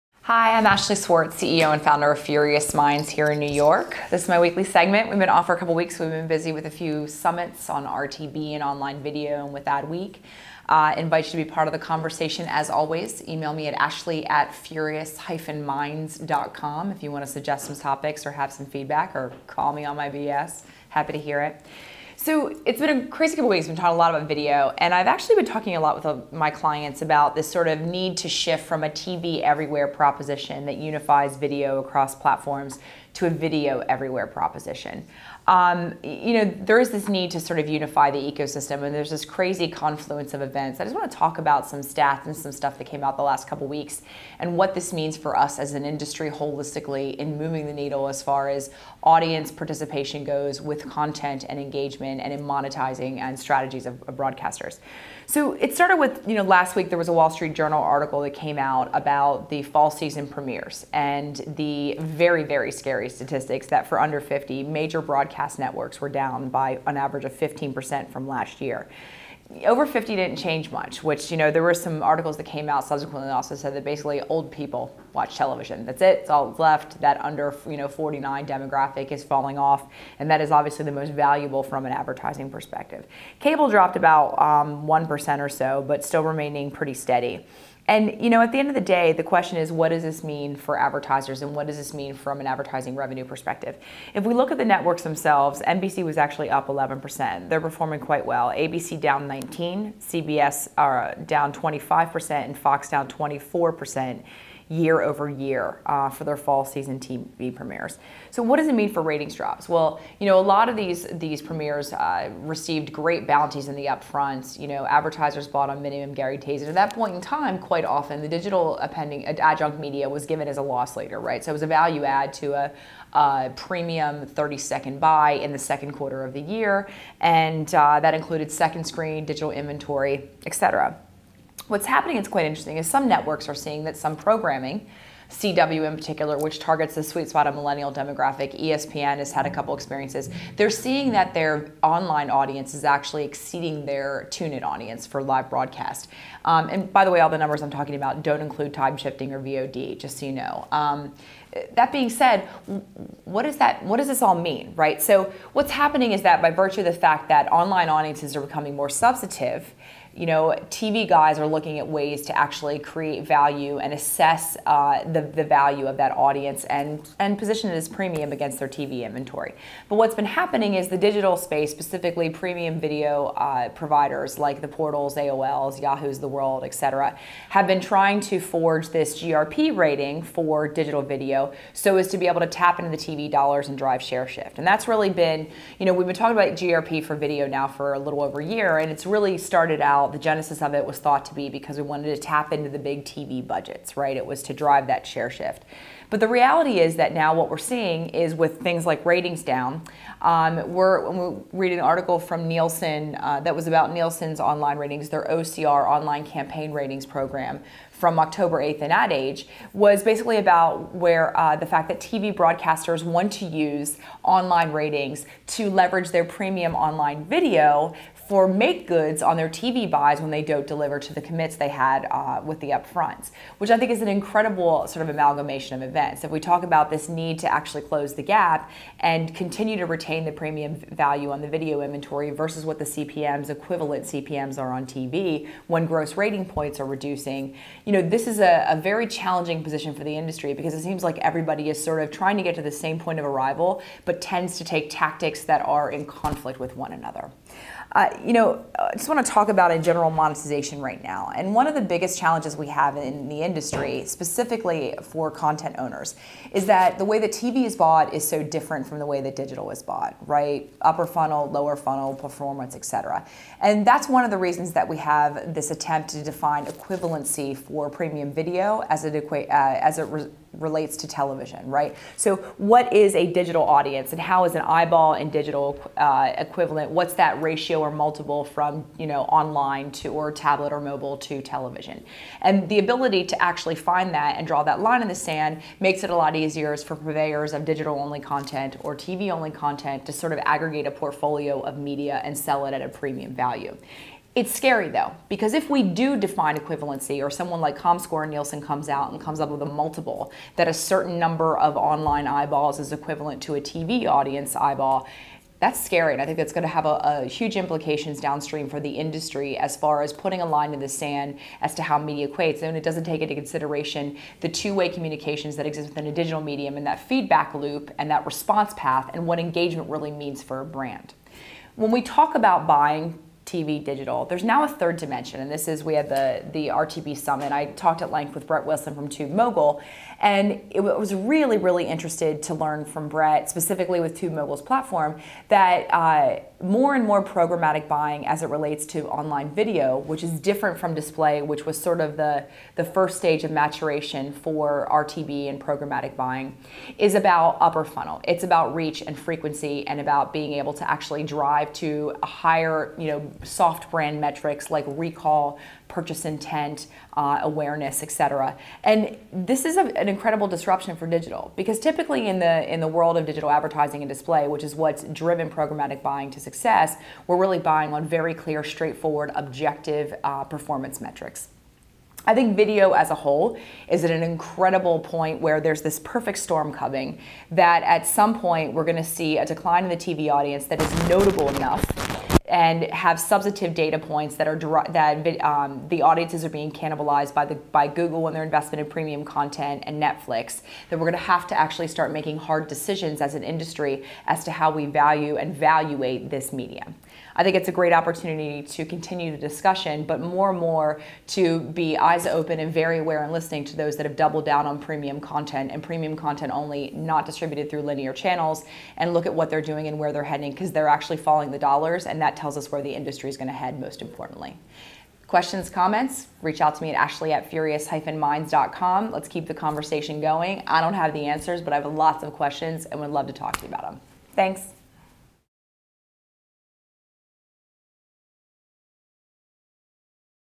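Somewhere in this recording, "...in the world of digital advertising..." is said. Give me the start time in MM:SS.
06:02.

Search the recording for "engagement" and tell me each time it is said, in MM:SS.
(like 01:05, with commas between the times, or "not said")
00:51, 05:19.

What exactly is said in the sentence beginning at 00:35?
Um, you know, there is this need to sort of unify the ecosystem, and there's this crazy confluence of events.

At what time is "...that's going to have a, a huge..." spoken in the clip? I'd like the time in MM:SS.
05:06.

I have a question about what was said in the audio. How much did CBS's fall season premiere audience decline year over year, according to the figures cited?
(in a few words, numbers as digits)
25%.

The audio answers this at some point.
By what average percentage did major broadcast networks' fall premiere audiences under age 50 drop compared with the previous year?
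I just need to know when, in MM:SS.
01:07.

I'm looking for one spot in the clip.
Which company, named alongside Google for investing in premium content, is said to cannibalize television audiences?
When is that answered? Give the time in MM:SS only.
06:30.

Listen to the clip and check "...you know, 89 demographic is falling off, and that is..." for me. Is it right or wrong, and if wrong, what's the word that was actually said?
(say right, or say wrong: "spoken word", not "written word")
wrong: "49", not "89".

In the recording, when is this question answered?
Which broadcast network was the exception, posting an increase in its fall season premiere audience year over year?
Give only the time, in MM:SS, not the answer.
01:35.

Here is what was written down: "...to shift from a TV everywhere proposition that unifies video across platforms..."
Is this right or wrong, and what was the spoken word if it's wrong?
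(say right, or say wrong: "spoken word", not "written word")
right.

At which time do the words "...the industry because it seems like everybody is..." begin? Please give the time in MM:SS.
04:00.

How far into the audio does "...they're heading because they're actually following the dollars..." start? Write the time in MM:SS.
06:50.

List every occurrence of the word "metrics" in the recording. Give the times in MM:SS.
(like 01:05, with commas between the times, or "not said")
05:54, 06:11.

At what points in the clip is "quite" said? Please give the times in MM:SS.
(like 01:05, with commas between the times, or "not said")
01:37, 01:57, 02:12.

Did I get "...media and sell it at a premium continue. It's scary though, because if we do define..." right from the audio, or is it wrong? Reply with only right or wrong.
wrong.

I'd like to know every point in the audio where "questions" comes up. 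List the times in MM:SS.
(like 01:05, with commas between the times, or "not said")
01:29, 06:55, 07:02.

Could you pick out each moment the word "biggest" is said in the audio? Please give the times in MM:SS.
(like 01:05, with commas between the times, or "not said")
04:11.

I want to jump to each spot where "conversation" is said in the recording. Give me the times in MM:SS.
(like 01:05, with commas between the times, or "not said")
00:11, 06:59.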